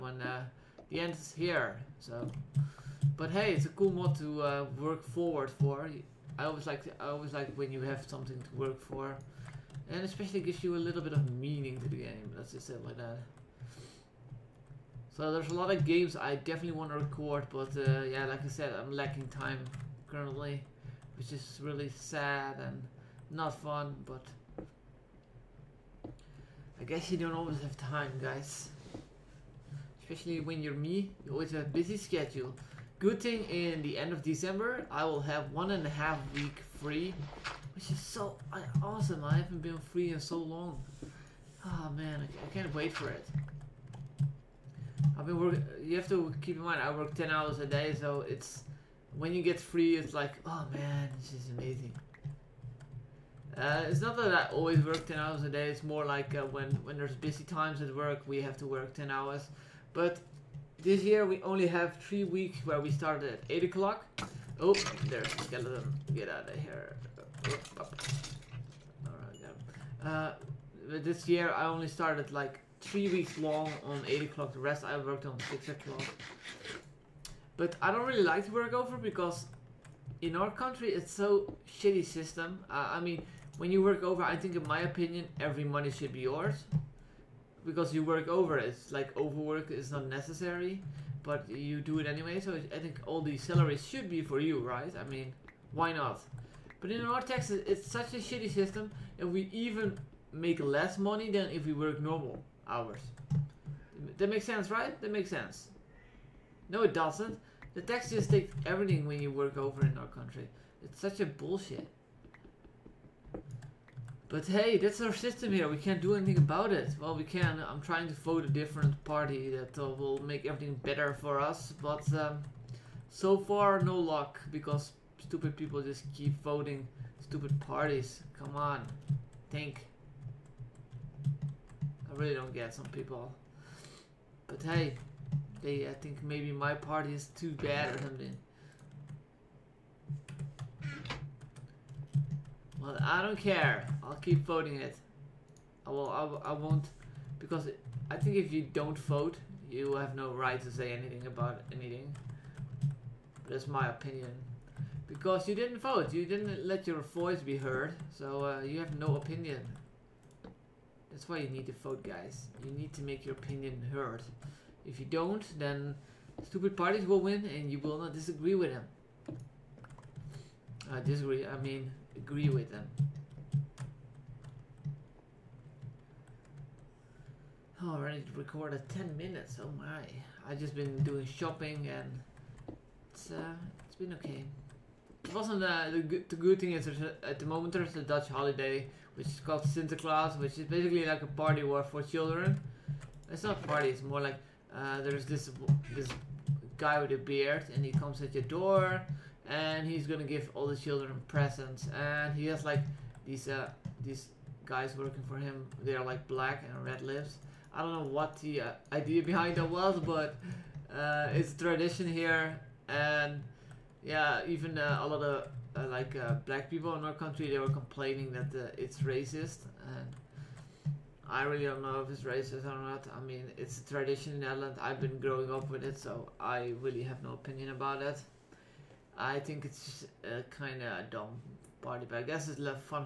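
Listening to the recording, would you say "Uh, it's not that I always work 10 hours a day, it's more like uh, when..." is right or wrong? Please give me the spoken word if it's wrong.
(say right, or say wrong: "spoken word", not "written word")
right.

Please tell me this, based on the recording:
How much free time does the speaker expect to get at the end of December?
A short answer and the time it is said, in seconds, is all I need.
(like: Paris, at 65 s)
1.5 weeks, at 35 s.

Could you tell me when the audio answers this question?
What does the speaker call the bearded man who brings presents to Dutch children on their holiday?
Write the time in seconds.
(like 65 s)
189 s.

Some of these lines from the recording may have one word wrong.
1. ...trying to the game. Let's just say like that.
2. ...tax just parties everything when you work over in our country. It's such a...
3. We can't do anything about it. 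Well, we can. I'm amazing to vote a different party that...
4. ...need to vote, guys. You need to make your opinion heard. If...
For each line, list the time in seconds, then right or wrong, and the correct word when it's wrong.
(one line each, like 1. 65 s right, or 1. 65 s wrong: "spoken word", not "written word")
1. 11 s wrong: "meaning", not "trying"
2. 107 s wrong: "takes", not "parties"
3. 115 s wrong: "trying", not "amazing"
4. 161 s right.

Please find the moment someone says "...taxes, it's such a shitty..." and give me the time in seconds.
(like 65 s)
97 s.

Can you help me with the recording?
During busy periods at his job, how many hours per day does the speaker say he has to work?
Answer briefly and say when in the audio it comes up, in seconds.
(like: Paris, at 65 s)
10 hours, at 47 s.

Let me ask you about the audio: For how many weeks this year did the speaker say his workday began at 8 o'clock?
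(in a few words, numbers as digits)
3 weeks.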